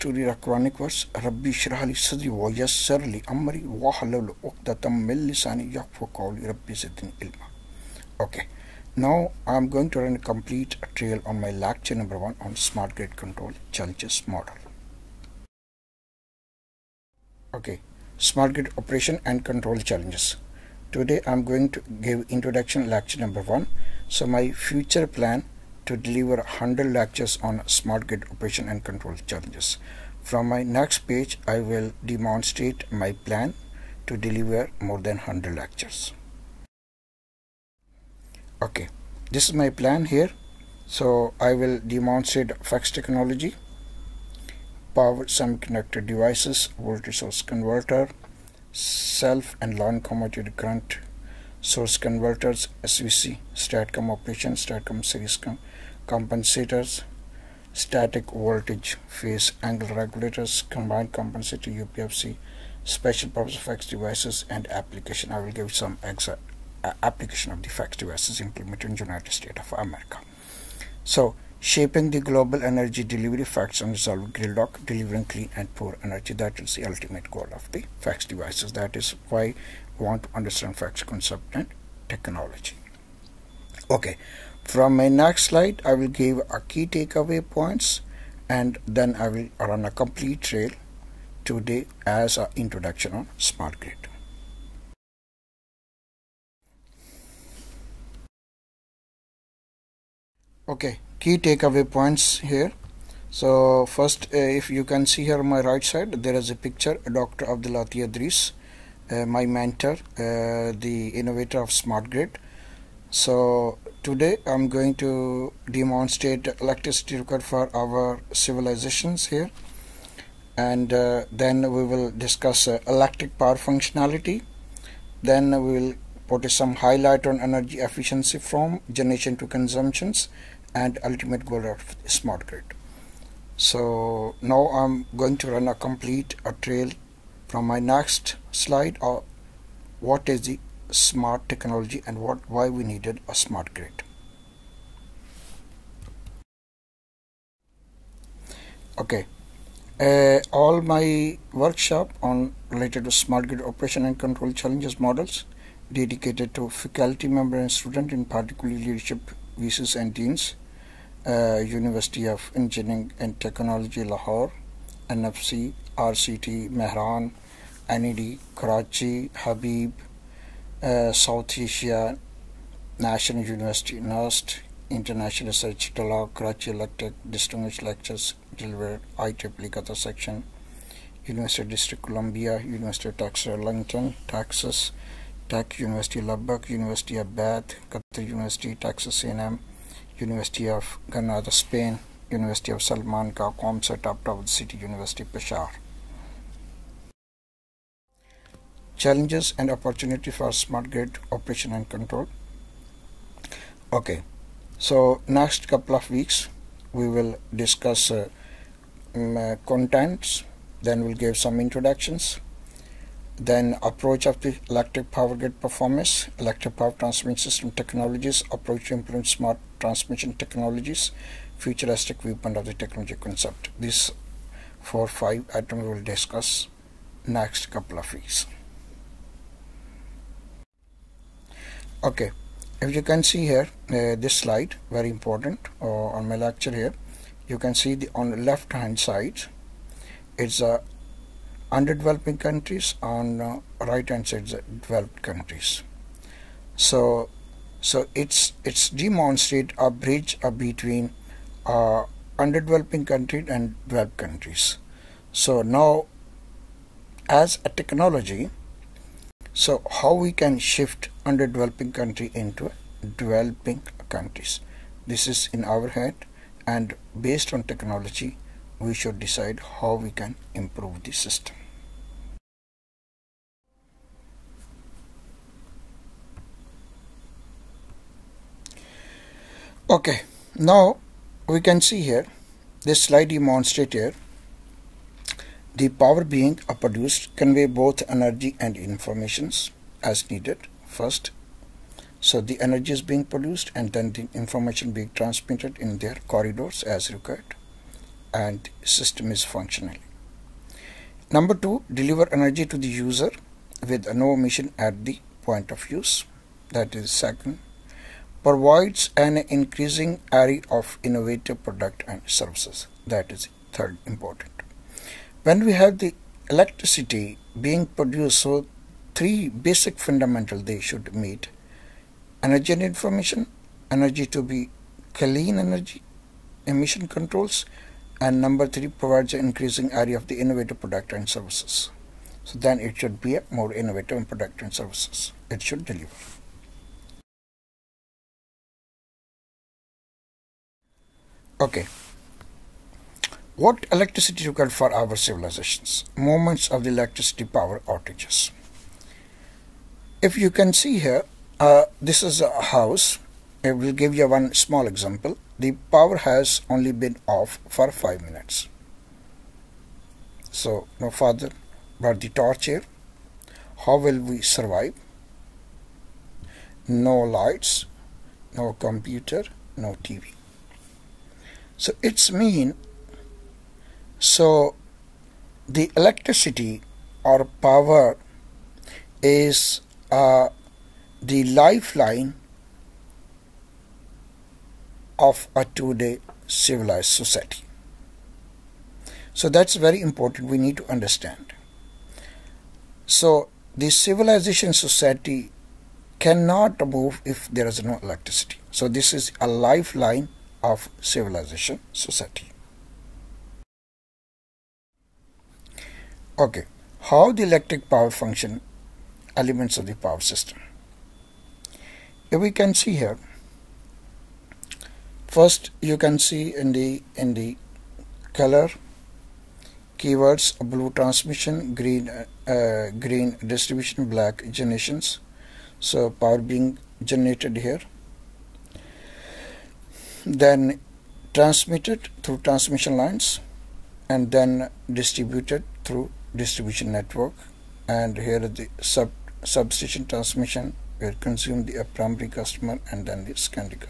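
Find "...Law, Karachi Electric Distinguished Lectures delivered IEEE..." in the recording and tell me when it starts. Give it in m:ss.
2:55.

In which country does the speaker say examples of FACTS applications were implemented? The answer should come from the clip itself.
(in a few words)
United States of America.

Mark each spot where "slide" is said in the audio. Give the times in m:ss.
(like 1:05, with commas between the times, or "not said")
1:25, 2:18, 3:54, 4:43.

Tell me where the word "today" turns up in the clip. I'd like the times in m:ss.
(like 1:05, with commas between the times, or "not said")
0:20, 1:31, 1:54.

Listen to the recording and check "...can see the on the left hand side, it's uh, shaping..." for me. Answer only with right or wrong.
wrong.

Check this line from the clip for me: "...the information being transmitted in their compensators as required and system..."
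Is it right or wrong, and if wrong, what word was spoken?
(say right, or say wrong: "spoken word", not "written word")
wrong: "corridors", not "compensators".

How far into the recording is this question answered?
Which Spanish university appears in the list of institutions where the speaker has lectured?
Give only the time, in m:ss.
3:10.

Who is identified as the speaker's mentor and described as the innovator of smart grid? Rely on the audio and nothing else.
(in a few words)
Dr. Abdel-Aty Edris.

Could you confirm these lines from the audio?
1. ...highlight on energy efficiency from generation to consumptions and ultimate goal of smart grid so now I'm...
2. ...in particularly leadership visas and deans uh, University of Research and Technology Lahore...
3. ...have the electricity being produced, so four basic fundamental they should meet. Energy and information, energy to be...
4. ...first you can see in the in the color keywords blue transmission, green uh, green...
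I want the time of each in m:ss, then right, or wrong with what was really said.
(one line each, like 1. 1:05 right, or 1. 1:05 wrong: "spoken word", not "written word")
1. 2:06 right
2. 2:38 wrong: "Engineering", not "Research"
3. 5:15 wrong: "three", not "four"
4. 6:55 right.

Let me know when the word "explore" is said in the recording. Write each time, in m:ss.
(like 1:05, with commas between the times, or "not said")
not said.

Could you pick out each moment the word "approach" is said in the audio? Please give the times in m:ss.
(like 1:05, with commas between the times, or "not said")
3:33, 3:38.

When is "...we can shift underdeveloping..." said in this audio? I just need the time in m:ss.
4:20.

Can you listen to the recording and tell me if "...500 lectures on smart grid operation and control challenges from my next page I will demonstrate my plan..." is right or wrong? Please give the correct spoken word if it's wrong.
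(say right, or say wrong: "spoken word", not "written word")
wrong: "100", not "500".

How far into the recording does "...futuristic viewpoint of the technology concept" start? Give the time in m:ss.
3:41.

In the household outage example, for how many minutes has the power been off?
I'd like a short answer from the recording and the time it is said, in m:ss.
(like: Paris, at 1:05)
5, at 5:57.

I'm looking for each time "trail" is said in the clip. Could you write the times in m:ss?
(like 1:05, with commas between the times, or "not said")
0:10, 1:30, 2:16.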